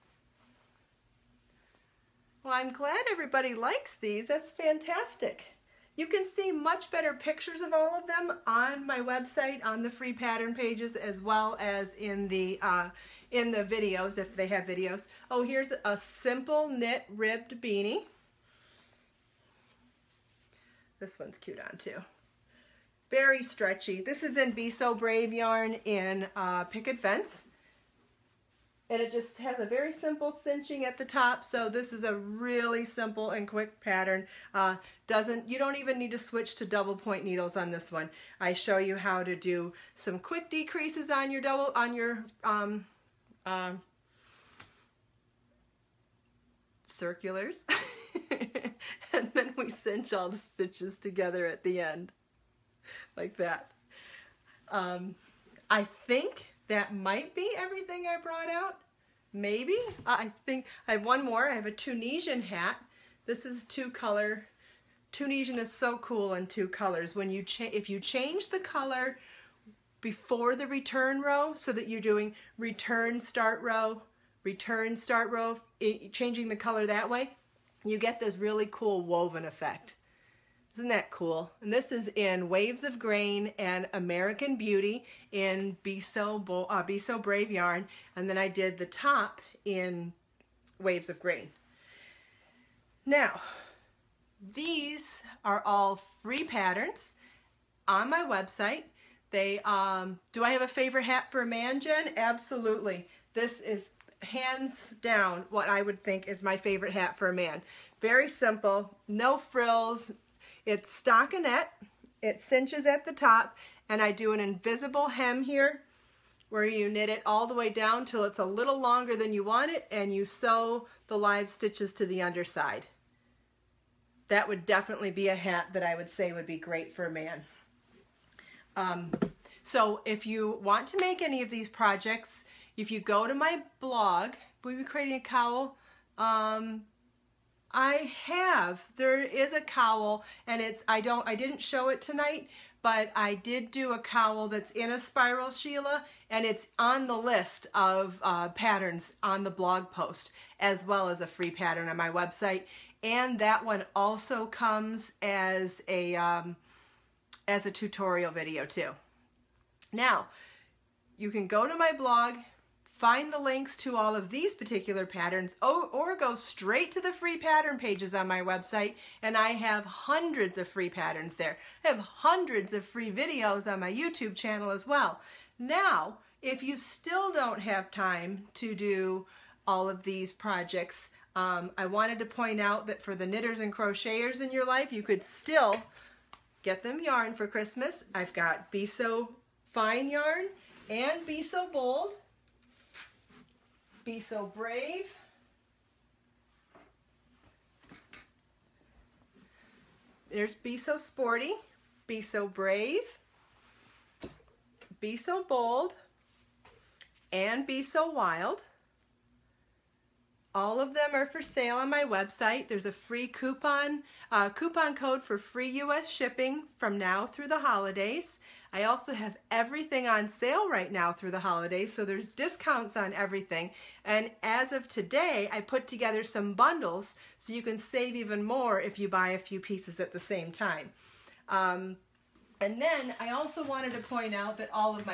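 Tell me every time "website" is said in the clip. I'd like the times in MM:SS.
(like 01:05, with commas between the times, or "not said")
00:09, 01:38, 02:32, 02:48, 03:32.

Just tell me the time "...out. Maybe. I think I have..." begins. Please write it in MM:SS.
00:58.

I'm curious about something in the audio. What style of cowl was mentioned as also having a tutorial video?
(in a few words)
spiral.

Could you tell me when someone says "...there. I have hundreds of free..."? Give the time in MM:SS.
02:51.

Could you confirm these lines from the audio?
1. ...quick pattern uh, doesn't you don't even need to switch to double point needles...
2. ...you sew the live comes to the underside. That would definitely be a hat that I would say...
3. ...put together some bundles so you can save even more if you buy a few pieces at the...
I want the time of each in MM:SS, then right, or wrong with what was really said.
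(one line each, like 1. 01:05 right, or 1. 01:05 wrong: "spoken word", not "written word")
1. 00:33 right
2. 02:00 wrong: "stitches", not "comes"
3. 03:45 right.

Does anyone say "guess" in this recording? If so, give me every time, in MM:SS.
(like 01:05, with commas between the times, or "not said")
not said.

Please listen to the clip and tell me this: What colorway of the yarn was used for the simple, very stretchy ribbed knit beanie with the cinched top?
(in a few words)
Picket Fence.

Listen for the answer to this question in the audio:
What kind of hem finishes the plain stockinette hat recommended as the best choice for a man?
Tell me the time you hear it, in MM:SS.
01:54.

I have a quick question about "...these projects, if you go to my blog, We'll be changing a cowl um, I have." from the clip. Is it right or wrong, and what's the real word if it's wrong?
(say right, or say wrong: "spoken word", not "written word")
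wrong: "creating", not "changing".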